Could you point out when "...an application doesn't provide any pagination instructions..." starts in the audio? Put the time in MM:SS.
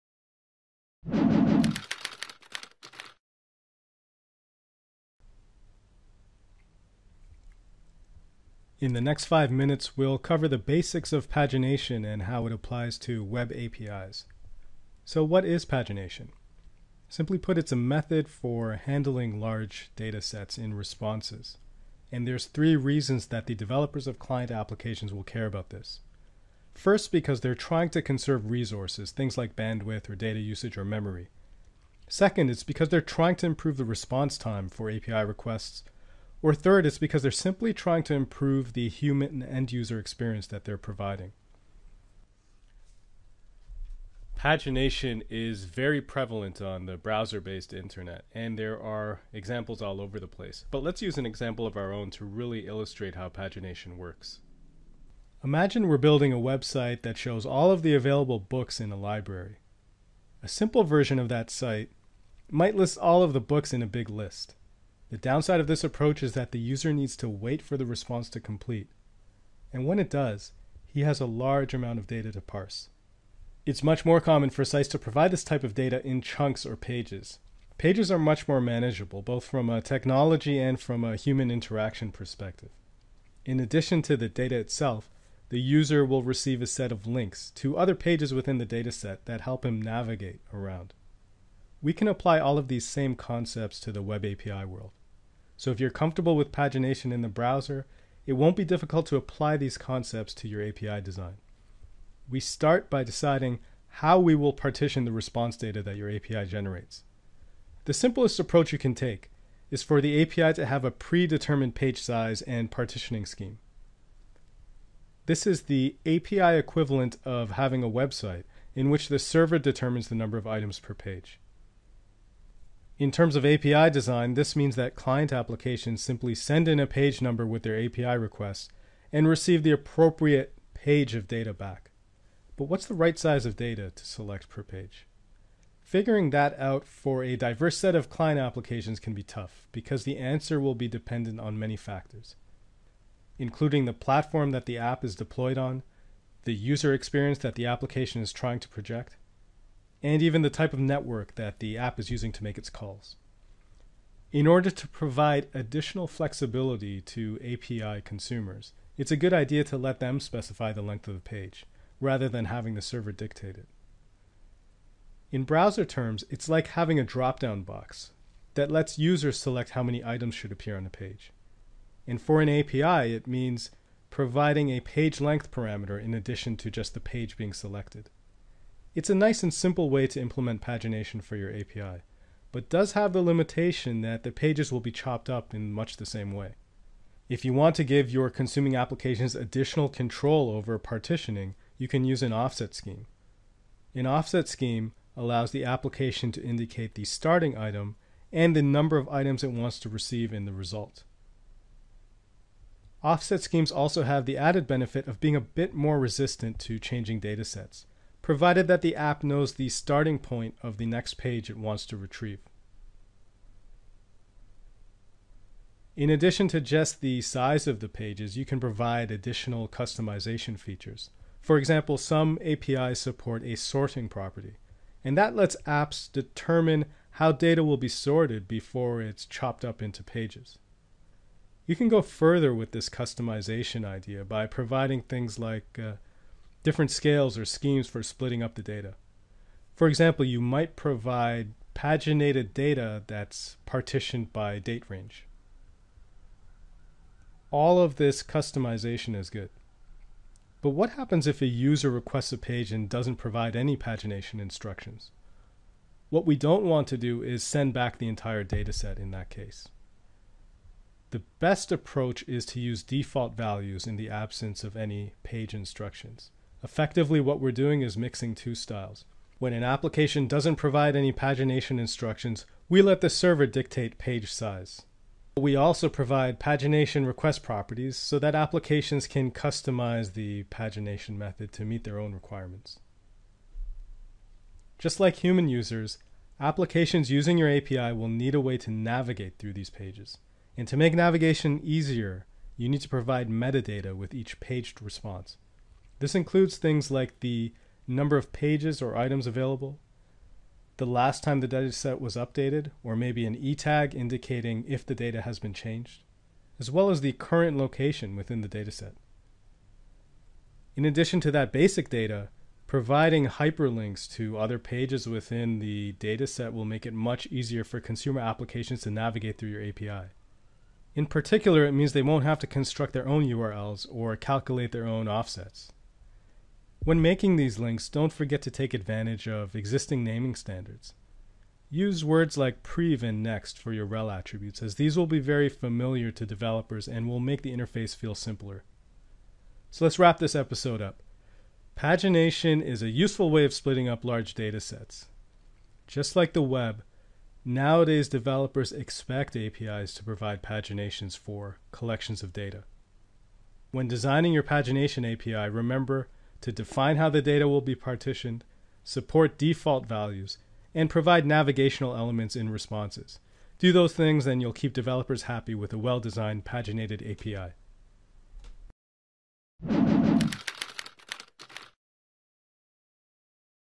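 04:29.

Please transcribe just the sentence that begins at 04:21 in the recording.
The best approach is to use default values in the absence of any page instructions.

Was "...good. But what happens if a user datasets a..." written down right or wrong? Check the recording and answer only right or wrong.
wrong.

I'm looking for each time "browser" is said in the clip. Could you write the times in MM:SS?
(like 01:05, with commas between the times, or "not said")
00:46, 01:37, 02:45.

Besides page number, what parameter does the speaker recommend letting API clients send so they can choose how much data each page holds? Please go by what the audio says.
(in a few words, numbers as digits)
page length.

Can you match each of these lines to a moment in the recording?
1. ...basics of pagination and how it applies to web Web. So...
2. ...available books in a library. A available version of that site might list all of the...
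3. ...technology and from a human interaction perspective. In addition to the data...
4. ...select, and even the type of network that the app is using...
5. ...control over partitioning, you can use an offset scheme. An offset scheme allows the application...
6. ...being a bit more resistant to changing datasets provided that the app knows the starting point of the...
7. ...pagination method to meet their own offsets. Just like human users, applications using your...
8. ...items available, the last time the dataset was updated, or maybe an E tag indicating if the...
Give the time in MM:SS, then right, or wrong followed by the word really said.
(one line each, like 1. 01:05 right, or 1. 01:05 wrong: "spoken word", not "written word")
1. 00:10 wrong: "APIs", not "Web"
2. 00:57 wrong: "simple", not "available"
3. 01:19 right
4. 02:28 wrong: "project", not "select"
5. 03:09 right
6. 03:25 right
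7. 04:40 wrong: "requirements", not "offsets"
8. 04:58 right.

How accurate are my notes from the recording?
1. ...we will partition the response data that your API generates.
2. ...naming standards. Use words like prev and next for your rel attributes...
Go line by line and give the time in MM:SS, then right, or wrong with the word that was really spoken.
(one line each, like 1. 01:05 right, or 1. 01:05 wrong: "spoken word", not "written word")
1. 01:44 right
2. 05:30 right.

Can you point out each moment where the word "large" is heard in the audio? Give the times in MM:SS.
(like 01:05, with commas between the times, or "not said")
00:19, 01:11, 05:44.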